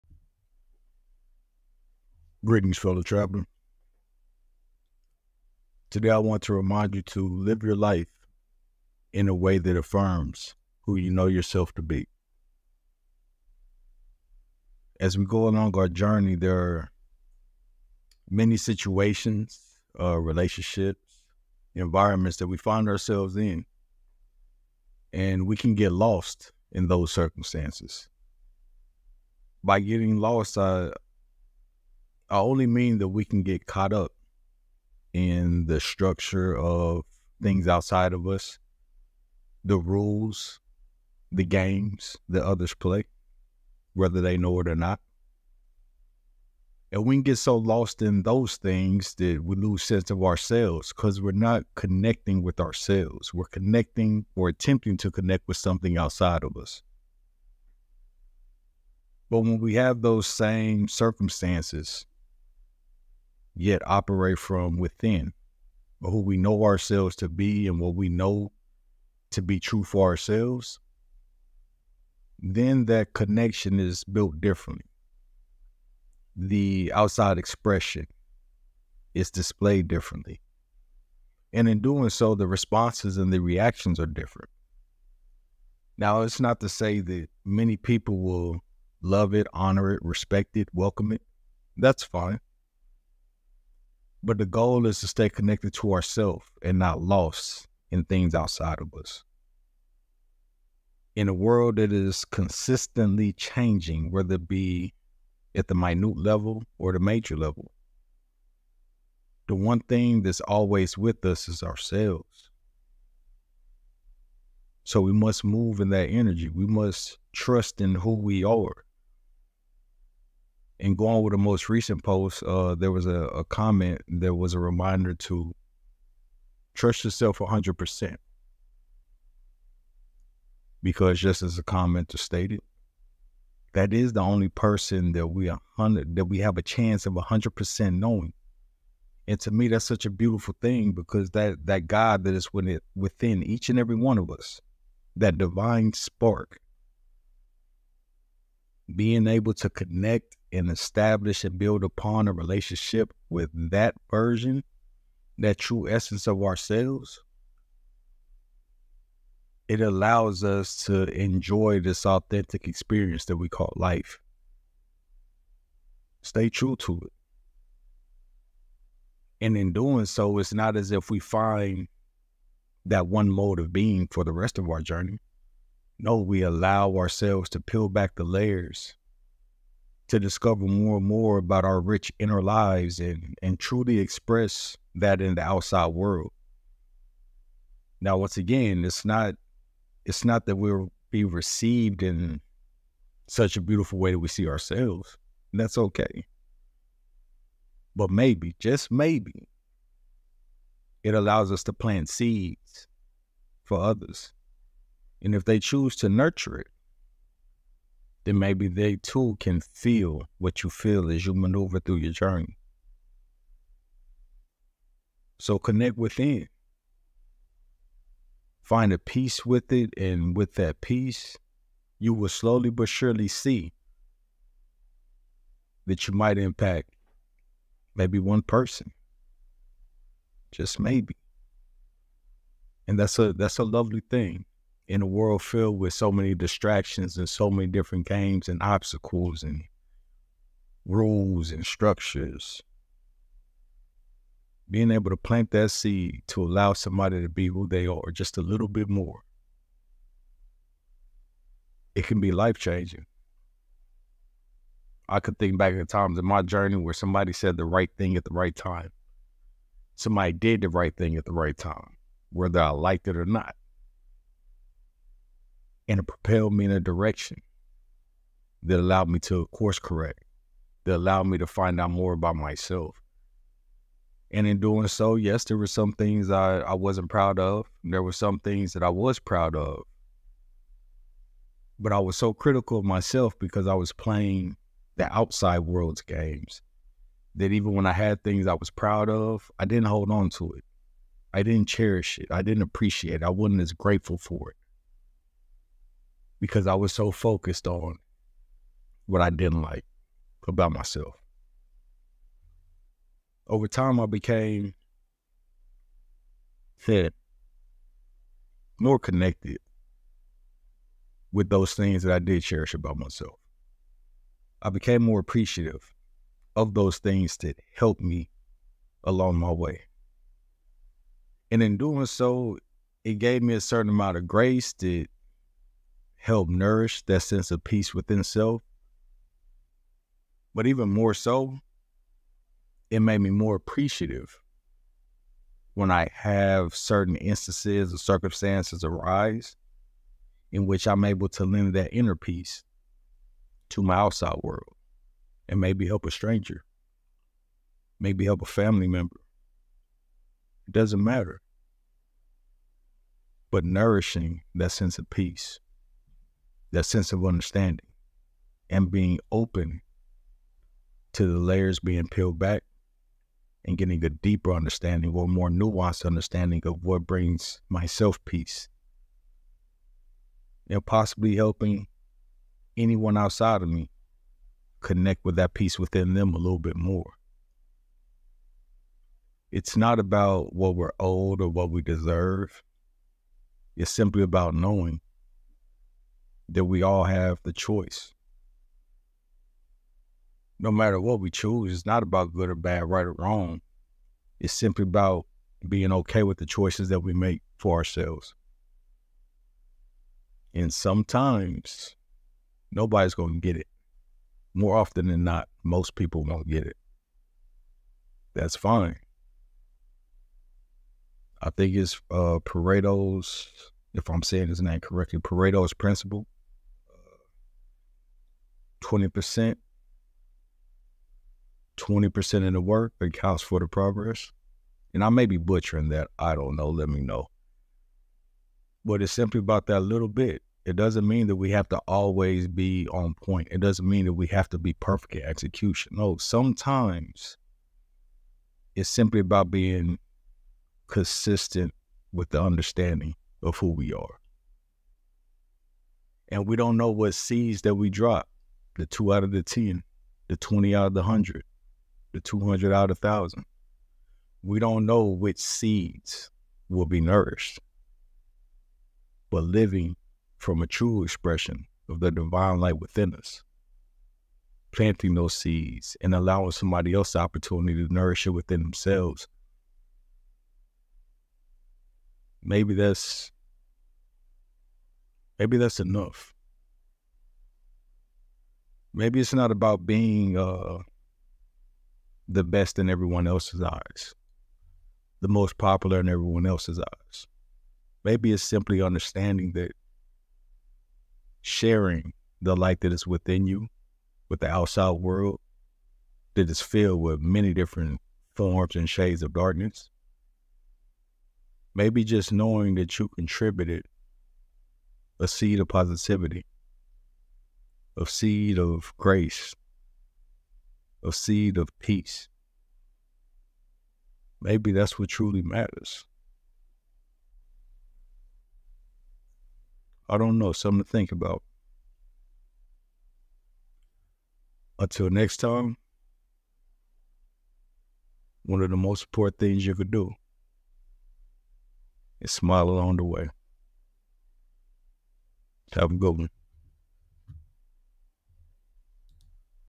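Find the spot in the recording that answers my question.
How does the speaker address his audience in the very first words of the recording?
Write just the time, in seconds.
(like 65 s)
2 s.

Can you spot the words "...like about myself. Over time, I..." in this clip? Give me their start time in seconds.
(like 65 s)
299 s.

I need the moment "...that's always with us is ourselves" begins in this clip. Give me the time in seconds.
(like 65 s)
110 s.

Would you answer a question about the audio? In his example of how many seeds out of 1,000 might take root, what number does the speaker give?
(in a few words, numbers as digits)
200.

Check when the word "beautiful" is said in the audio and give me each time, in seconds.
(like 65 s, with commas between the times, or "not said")
140 s, 193 s.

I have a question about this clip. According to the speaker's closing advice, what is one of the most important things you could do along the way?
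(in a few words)
smile.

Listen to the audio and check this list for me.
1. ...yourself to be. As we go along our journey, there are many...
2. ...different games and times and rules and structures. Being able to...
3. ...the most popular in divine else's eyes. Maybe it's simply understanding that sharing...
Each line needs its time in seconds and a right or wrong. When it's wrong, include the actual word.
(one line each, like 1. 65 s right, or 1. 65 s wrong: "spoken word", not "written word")
1. 11 s right
2. 237 s wrong: "obstacles", not "times"
3. 485 s wrong: "everyone", not "divine".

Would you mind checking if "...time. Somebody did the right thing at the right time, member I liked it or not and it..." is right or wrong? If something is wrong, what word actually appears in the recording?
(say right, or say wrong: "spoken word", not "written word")
wrong: "whether", not "member".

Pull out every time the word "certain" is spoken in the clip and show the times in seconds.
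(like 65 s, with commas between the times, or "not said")
323 s, 336 s.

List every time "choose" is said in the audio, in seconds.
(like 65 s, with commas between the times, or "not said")
205 s, 391 s.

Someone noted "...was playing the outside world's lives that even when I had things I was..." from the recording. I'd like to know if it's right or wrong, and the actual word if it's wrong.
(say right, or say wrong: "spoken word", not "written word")
wrong: "games", not "lives".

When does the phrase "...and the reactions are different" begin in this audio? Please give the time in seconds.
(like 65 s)
83 s.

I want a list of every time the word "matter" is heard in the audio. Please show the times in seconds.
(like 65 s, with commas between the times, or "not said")
351 s, 390 s, 515 s.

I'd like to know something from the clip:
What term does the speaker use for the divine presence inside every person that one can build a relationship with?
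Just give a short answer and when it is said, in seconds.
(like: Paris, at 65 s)
divine spark, at 145 s.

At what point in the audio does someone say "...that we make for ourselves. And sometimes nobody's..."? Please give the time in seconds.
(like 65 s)
396 s.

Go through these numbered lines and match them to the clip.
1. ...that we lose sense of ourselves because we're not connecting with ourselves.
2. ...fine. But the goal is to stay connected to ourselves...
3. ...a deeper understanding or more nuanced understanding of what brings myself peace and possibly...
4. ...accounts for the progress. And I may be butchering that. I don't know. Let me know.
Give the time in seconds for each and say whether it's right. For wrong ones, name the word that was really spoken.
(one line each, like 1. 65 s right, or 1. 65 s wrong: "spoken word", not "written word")
1. 49 s right
2. 92 s right
3. 364 s right
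4. 422 s right.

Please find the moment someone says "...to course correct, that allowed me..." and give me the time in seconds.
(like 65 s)
269 s.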